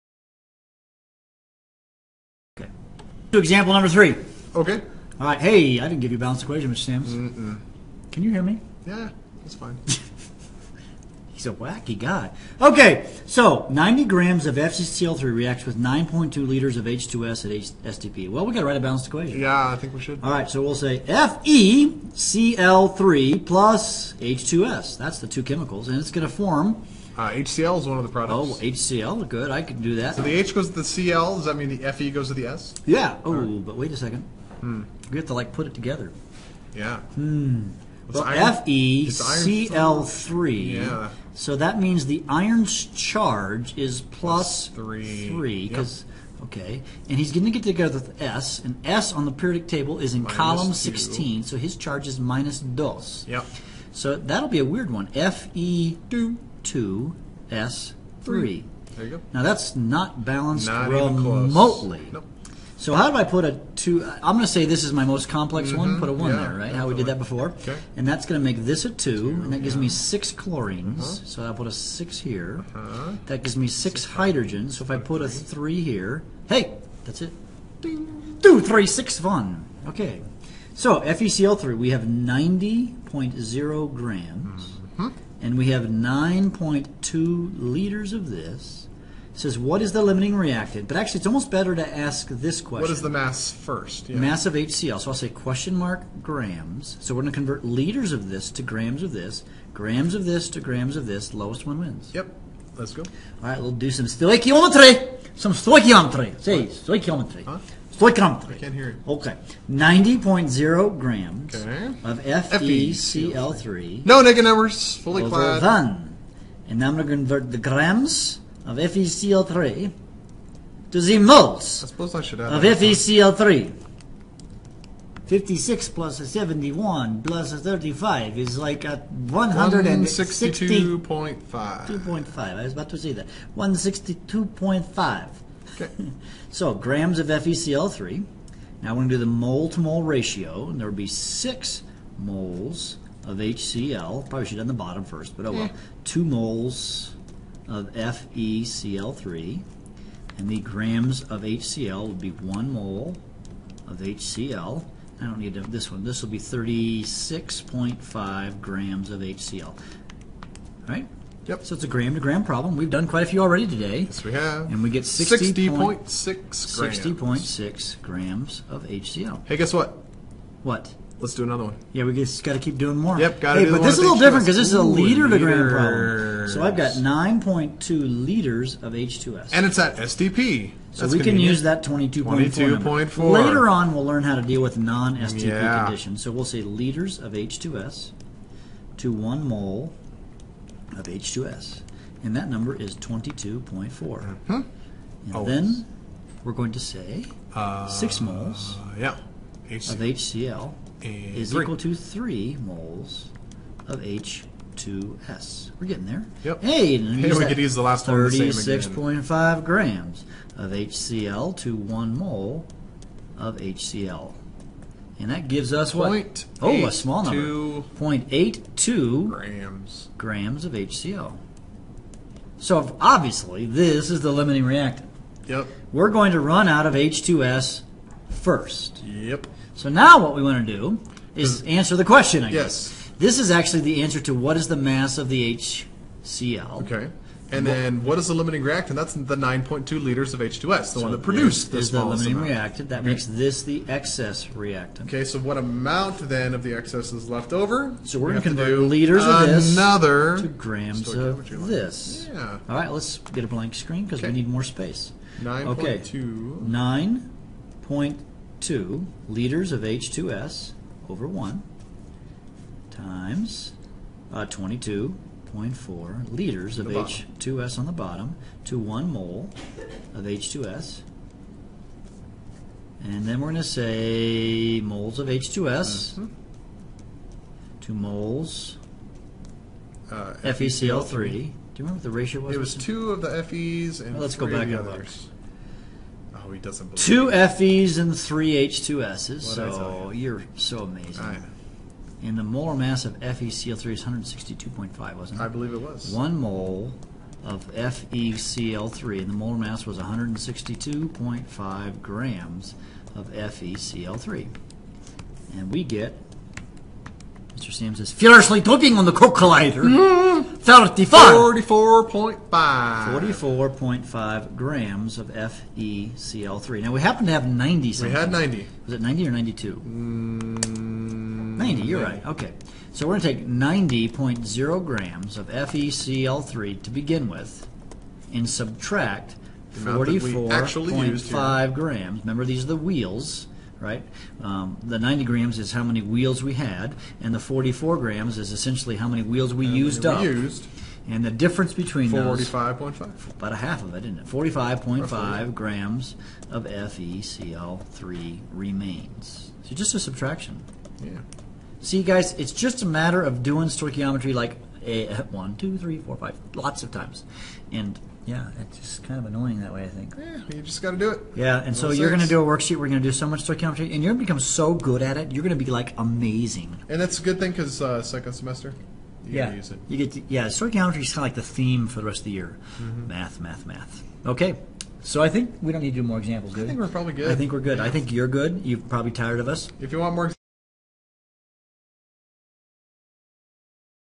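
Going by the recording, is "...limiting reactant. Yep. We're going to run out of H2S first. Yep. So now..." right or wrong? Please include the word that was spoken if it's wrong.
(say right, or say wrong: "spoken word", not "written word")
right.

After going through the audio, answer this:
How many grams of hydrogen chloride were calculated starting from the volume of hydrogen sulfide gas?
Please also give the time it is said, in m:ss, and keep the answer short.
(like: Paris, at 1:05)
0.82 grams, at 3:37.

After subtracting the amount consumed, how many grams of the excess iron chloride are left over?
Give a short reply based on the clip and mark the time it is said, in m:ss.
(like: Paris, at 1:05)
45.5 grams, at 5:44.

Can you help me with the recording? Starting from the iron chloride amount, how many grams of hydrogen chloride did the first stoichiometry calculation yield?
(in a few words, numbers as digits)
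60.6 grams.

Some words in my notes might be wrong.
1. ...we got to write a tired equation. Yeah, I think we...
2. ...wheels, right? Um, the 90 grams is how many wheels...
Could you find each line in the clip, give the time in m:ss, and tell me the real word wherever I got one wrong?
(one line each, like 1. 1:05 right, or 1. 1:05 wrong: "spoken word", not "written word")
1. 0:18 wrong: "balanced", not "tired"
2. 5:32 right.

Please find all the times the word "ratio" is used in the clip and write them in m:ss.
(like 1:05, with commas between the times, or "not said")
2:20, 4:42.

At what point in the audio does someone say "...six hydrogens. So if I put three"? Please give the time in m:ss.
1:14.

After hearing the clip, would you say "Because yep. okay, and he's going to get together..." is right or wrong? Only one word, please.
right.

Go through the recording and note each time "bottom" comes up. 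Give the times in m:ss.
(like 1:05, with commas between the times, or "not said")
2:24, 4:27.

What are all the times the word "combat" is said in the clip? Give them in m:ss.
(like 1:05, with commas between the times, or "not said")
not said.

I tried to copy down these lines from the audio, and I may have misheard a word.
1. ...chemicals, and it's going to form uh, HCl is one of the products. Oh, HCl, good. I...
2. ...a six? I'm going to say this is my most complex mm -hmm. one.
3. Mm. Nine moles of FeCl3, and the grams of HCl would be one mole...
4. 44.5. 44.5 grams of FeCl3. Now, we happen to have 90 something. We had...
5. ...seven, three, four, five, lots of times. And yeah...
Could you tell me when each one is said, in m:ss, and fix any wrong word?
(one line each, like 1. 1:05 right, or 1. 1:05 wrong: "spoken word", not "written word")
1. 0:25 right
2. 1:03 wrong: "two", not "six"
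3. 2:25 wrong: "Two", not "Nine"
4. 5:11 right
5. 5:55 wrong: "two", not "seven".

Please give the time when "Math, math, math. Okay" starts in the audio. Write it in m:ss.
6:13.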